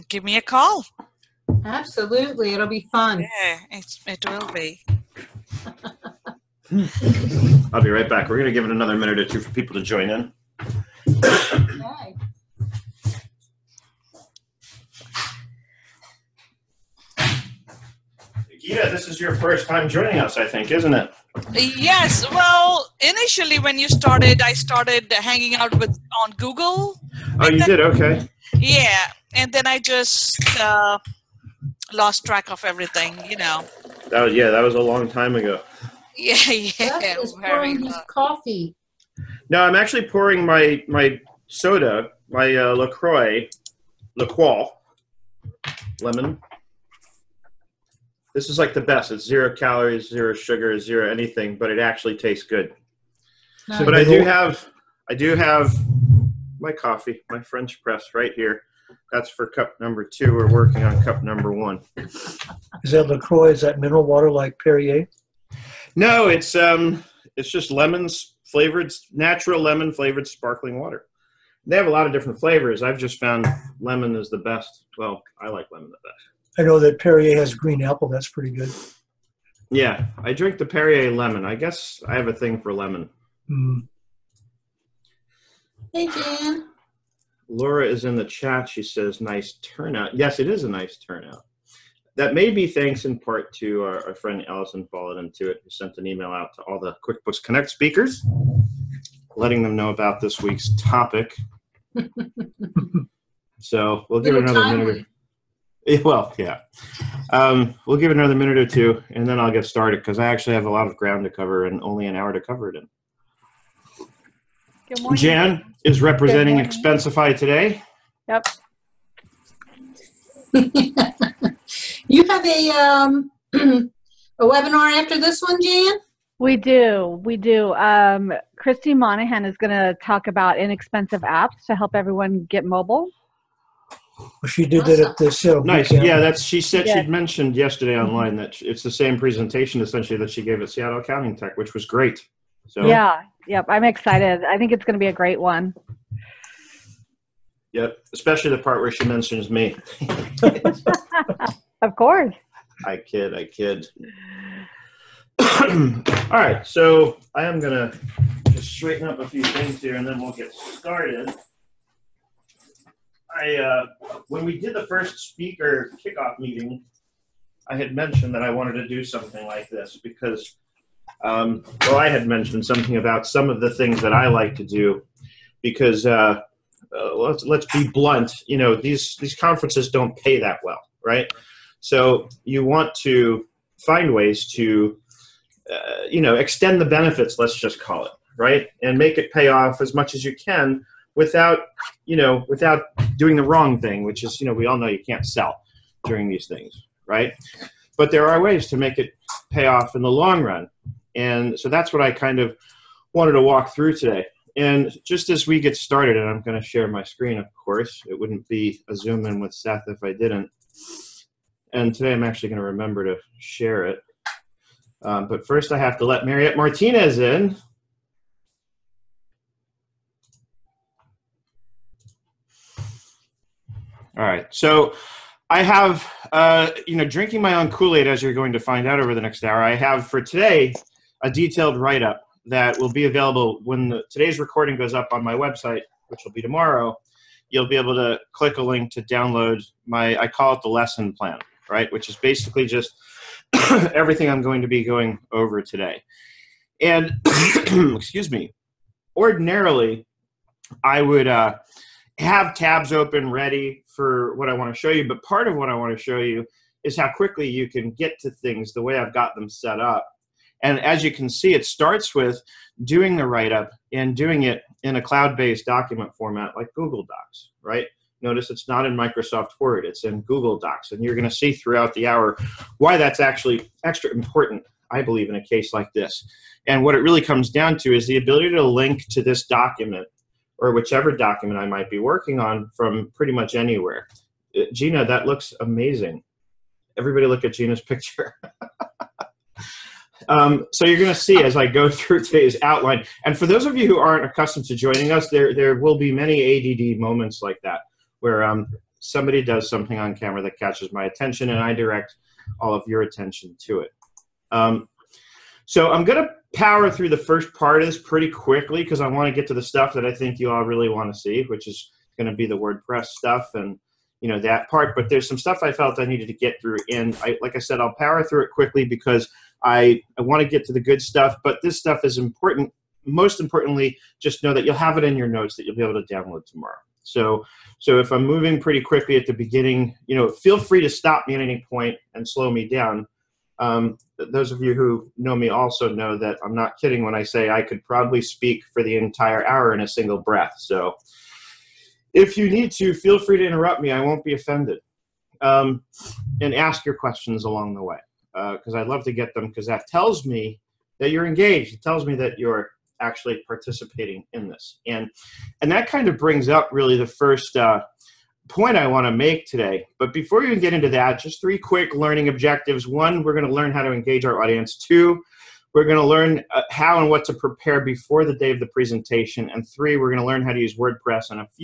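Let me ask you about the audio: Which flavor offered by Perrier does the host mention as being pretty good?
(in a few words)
Green apple.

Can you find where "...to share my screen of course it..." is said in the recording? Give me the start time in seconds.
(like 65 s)
206 s.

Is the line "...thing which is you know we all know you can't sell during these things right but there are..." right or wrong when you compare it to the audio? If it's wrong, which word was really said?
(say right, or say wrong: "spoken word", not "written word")
right.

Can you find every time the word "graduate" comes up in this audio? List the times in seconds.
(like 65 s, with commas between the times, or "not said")
not said.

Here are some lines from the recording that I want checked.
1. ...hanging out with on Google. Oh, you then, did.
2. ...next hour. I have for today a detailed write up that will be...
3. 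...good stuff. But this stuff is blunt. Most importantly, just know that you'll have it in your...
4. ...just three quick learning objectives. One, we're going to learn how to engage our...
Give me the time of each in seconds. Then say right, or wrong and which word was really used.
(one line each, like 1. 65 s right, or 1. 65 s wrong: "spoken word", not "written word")
1. 25 s right
2. 229 s right
3. 320 s wrong: "important", not "blunt"
4. 361 s right.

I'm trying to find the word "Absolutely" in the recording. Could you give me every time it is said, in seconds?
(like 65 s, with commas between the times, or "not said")
1 s.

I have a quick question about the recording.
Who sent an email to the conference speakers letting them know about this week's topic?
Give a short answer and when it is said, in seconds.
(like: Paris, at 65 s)
Allison, at 94 s.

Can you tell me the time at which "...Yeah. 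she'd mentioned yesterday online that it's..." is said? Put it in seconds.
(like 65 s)
136 s.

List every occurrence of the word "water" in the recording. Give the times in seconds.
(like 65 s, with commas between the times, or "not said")
64 s, 70 s.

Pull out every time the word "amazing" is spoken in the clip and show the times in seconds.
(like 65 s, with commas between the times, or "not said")
285 s.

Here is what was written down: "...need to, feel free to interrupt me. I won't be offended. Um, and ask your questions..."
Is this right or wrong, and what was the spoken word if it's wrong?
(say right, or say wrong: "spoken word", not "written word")
right.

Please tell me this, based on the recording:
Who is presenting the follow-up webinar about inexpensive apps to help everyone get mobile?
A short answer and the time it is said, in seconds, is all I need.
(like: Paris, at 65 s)
Christy Monahan, at 128 s.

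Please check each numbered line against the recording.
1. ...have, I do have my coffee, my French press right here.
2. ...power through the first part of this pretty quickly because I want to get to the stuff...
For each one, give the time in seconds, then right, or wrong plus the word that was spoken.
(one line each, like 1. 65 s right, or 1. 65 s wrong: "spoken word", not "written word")
1. 54 s right
2. 306 s right.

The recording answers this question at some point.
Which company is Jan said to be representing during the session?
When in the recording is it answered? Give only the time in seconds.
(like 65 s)
116 s.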